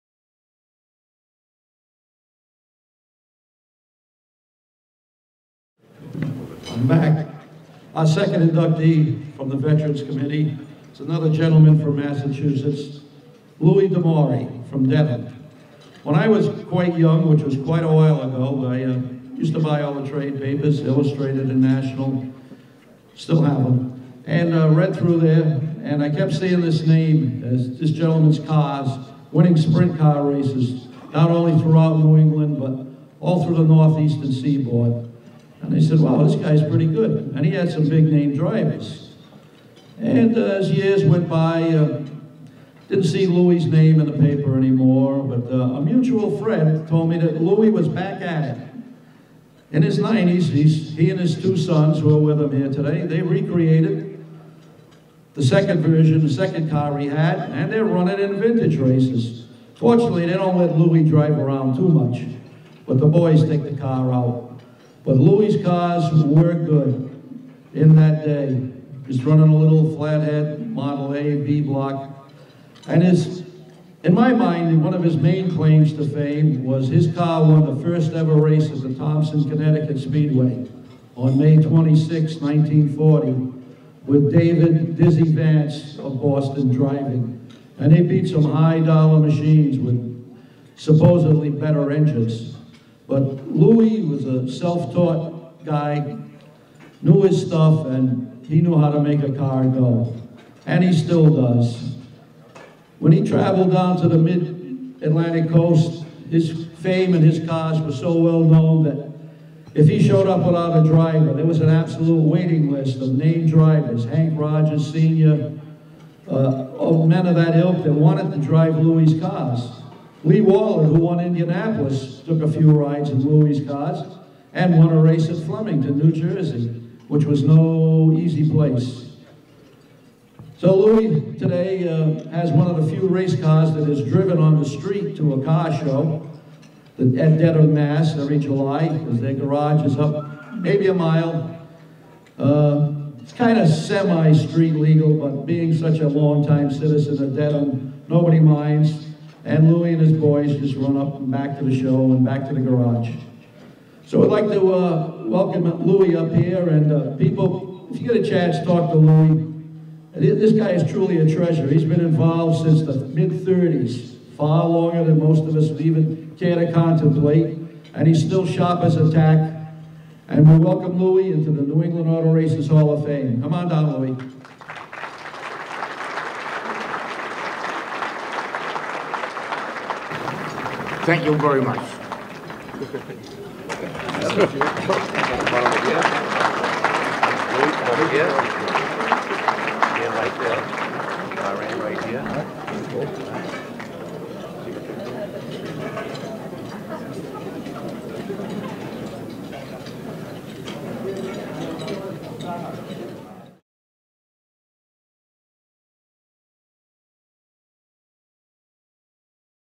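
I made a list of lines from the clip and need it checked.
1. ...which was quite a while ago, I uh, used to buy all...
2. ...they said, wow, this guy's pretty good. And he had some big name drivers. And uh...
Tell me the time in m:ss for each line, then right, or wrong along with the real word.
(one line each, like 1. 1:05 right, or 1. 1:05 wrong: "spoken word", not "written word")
1. 0:17 right
2. 0:35 right.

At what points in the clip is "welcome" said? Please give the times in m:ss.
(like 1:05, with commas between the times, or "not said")
2:35, 2:50.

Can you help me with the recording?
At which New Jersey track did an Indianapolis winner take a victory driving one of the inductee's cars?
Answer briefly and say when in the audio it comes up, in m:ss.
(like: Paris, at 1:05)
Flemington, at 2:05.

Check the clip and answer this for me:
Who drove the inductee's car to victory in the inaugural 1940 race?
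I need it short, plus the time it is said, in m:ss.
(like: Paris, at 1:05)
David Dizzy Vance, at 1:24.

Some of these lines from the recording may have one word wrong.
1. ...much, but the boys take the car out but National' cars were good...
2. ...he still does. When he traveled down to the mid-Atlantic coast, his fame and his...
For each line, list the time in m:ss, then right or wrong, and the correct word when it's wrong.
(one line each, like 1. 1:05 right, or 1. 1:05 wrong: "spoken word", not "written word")
1. 1:01 wrong: "Louis", not "National"
2. 1:40 right.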